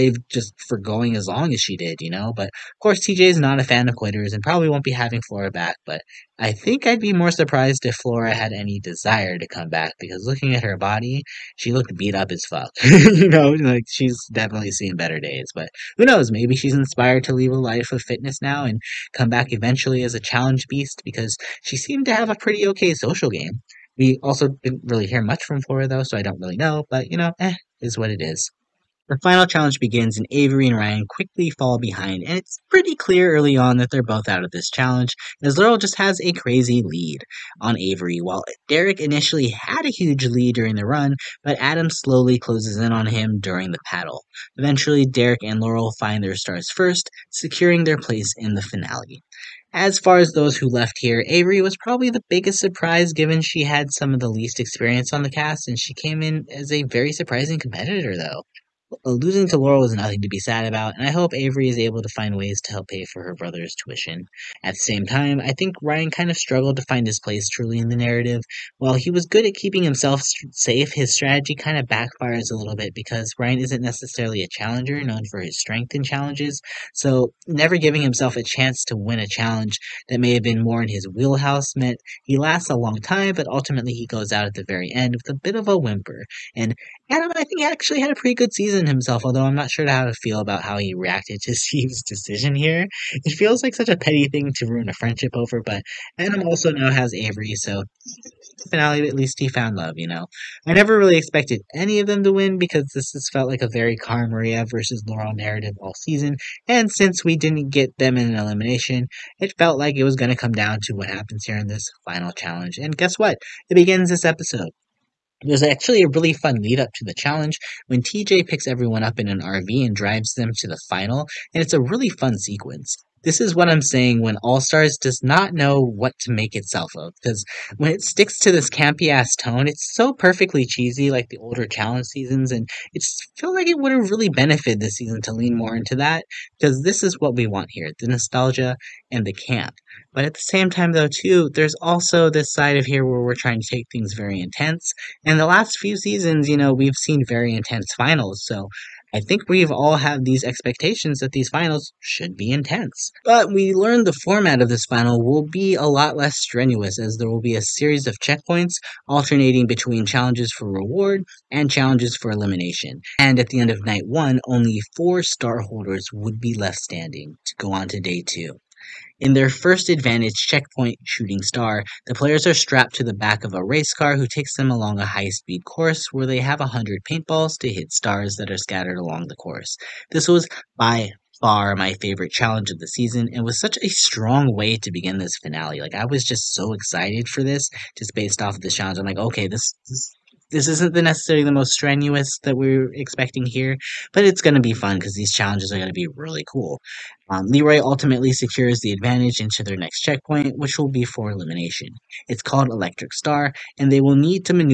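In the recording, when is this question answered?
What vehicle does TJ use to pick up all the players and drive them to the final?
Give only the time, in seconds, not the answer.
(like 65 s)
119 s.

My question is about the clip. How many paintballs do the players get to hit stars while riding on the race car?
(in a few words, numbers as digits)
100.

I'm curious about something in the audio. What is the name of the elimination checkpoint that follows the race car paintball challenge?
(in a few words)
Electric Star.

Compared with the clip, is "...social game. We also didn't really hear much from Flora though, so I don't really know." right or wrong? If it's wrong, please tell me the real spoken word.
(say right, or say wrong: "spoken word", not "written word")
right.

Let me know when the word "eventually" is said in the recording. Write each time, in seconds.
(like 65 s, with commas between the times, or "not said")
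19 s, 44 s.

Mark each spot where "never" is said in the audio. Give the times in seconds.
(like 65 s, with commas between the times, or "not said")
77 s, 100 s.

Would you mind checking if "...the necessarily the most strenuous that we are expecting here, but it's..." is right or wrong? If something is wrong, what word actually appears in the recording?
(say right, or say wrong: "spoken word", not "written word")
right.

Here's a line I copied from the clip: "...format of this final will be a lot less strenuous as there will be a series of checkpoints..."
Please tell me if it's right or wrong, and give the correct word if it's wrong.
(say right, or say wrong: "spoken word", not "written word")
right.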